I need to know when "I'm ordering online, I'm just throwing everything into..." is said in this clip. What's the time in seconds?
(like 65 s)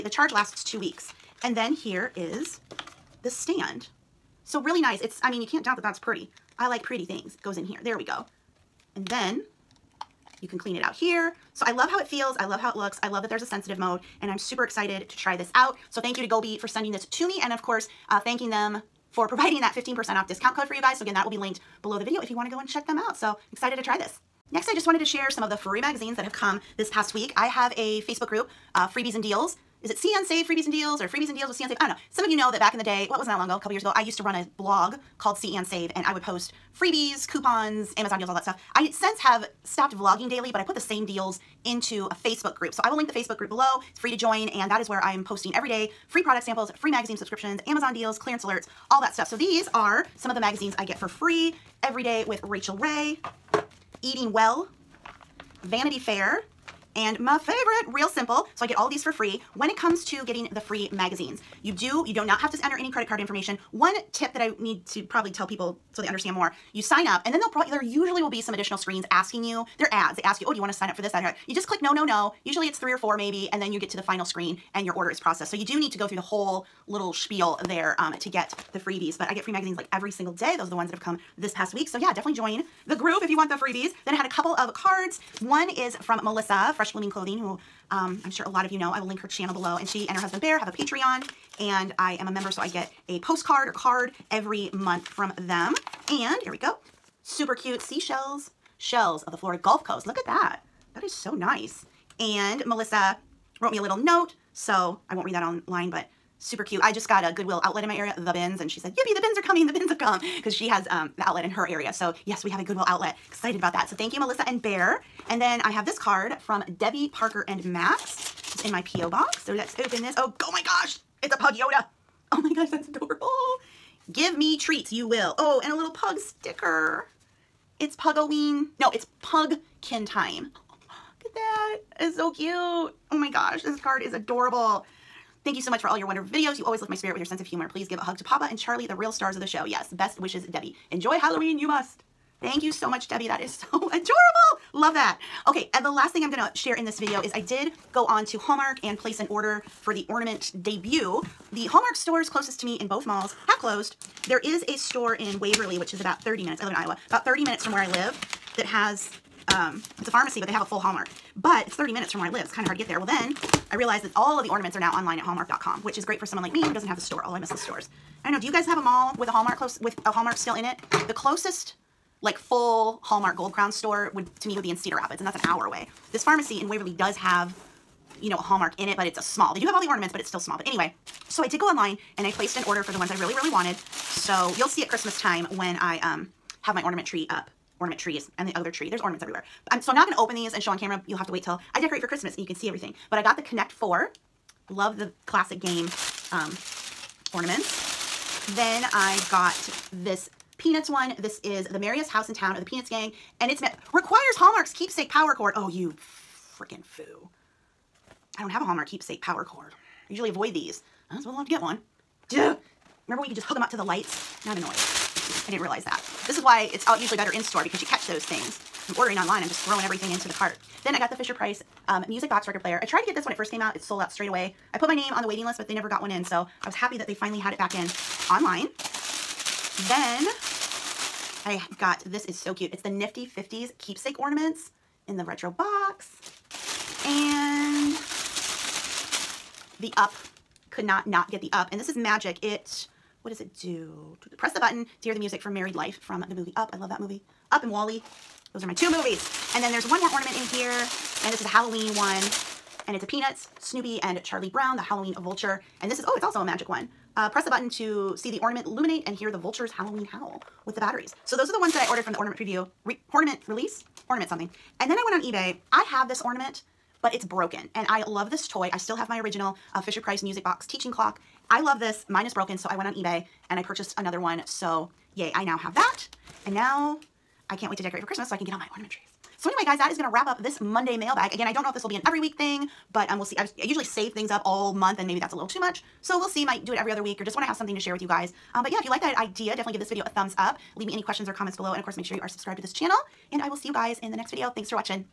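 218 s.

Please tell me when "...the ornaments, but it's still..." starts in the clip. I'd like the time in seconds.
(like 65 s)
179 s.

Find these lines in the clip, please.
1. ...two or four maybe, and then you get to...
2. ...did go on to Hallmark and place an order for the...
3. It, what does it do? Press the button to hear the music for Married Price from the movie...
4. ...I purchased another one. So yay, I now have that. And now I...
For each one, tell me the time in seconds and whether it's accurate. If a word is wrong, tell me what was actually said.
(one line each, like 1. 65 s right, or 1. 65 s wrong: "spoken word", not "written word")
1. 72 s wrong: "three", not "two"
2. 147 s right
3. 242 s wrong: "Life", not "Price"
4. 273 s right.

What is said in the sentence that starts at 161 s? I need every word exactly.
But it's 30 minutes from where I live.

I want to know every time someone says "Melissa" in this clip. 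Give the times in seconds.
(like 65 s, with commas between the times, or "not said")
86 s, 102 s, 114 s.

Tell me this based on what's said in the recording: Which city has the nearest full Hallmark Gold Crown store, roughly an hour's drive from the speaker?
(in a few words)
Cedar Rapids.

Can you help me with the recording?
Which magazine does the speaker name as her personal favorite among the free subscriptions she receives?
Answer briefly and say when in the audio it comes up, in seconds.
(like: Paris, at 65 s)
Real Simple, at 57 s.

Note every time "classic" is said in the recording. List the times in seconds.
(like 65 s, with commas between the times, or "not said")
195 s.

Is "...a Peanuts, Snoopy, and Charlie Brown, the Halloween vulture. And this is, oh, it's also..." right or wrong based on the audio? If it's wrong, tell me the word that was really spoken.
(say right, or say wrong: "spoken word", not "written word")
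right.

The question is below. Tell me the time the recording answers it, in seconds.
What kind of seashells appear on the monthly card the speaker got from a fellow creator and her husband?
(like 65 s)
98 s.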